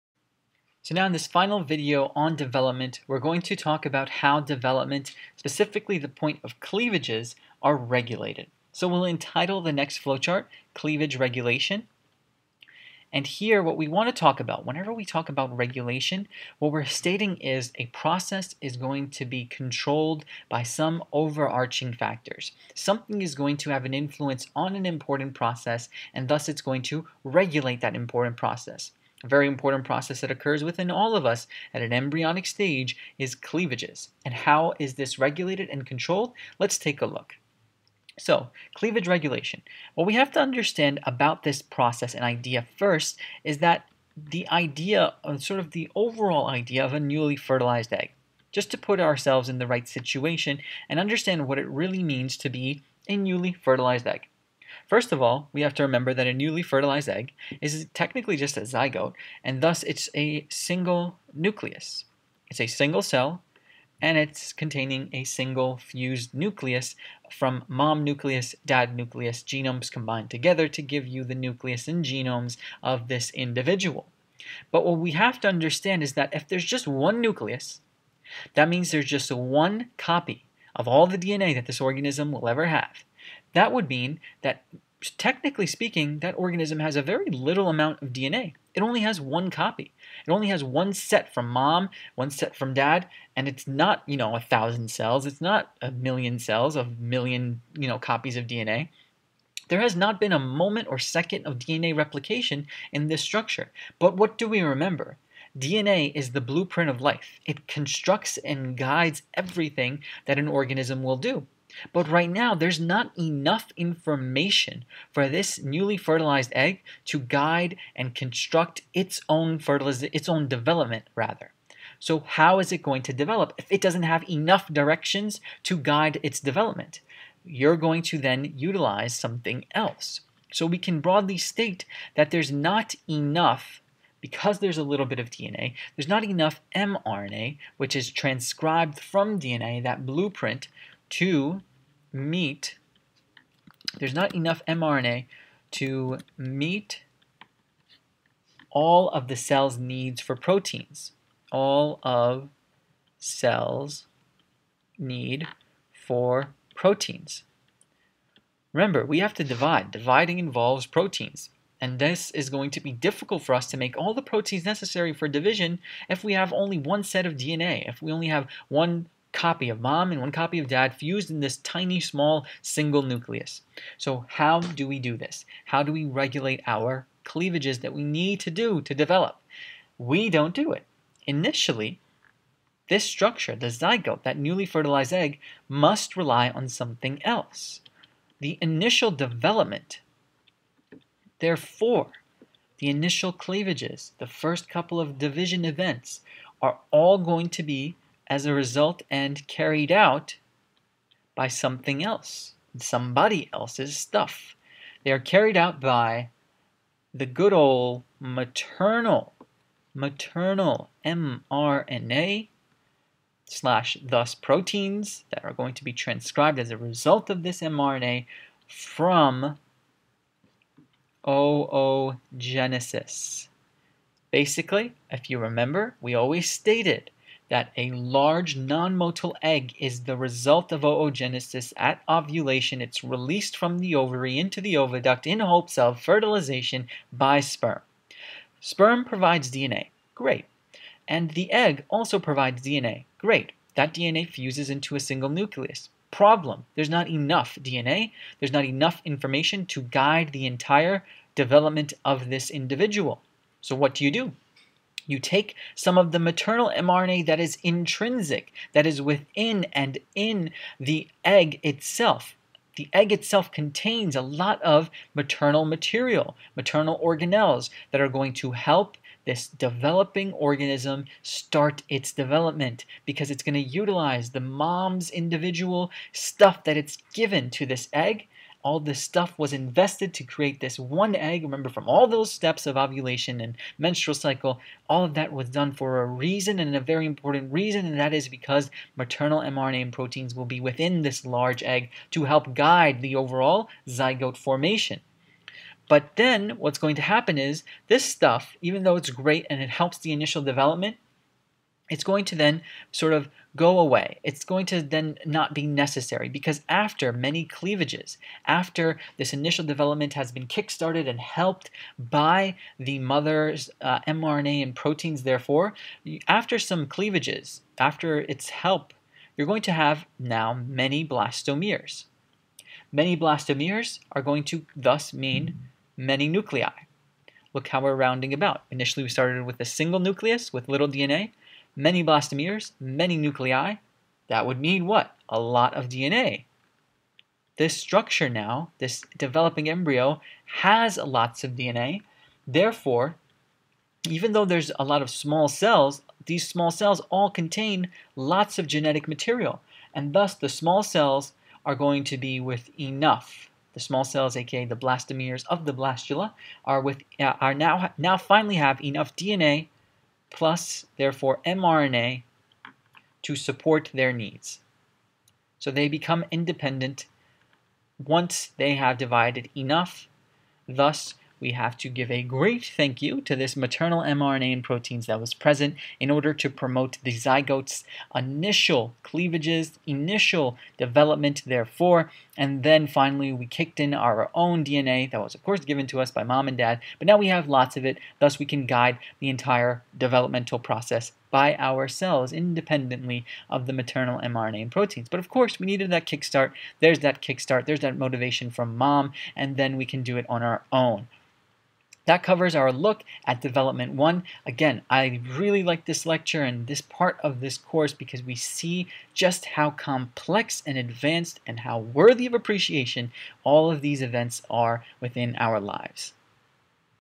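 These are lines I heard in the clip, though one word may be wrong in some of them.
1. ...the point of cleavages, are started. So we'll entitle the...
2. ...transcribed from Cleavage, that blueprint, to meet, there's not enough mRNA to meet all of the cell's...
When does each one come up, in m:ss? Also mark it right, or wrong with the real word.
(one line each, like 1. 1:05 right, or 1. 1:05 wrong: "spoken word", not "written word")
1. 0:05 wrong: "regulated", not "started"
2. 2:18 wrong: "DNA", not "Cleavage".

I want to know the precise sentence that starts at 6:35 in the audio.
But of course, we needed that kickstart.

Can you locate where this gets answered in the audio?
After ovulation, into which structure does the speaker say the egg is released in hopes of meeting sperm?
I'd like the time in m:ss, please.
3:54.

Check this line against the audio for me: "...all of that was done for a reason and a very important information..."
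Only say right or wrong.
wrong.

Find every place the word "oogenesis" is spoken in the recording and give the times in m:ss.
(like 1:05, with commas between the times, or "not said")
3:41, 3:50.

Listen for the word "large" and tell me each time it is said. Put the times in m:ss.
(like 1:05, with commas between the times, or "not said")
3:47, 4:51.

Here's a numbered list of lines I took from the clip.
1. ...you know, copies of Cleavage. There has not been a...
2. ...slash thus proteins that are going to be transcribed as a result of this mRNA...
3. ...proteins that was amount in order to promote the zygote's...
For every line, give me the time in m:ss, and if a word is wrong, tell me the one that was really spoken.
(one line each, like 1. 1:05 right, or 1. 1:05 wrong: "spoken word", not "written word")
1. 1:37 wrong: "DNA", not "Cleavage"
2. 3:33 right
3. 6:14 wrong: "present", not "amount".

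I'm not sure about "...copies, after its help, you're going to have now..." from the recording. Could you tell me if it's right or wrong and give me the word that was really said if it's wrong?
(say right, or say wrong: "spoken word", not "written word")
wrong: "cleavages", not "copies".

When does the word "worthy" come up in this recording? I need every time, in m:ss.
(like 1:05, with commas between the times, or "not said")
6:51.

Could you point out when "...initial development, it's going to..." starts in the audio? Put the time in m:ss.
5:00.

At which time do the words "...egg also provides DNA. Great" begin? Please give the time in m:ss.
4:01.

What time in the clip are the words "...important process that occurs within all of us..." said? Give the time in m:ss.
0:29.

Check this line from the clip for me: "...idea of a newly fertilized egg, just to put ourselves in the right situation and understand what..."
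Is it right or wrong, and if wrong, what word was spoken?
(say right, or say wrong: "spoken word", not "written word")
right.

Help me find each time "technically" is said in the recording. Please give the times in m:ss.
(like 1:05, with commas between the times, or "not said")
0:57, 1:25.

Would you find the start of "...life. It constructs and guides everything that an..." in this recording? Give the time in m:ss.
1:47.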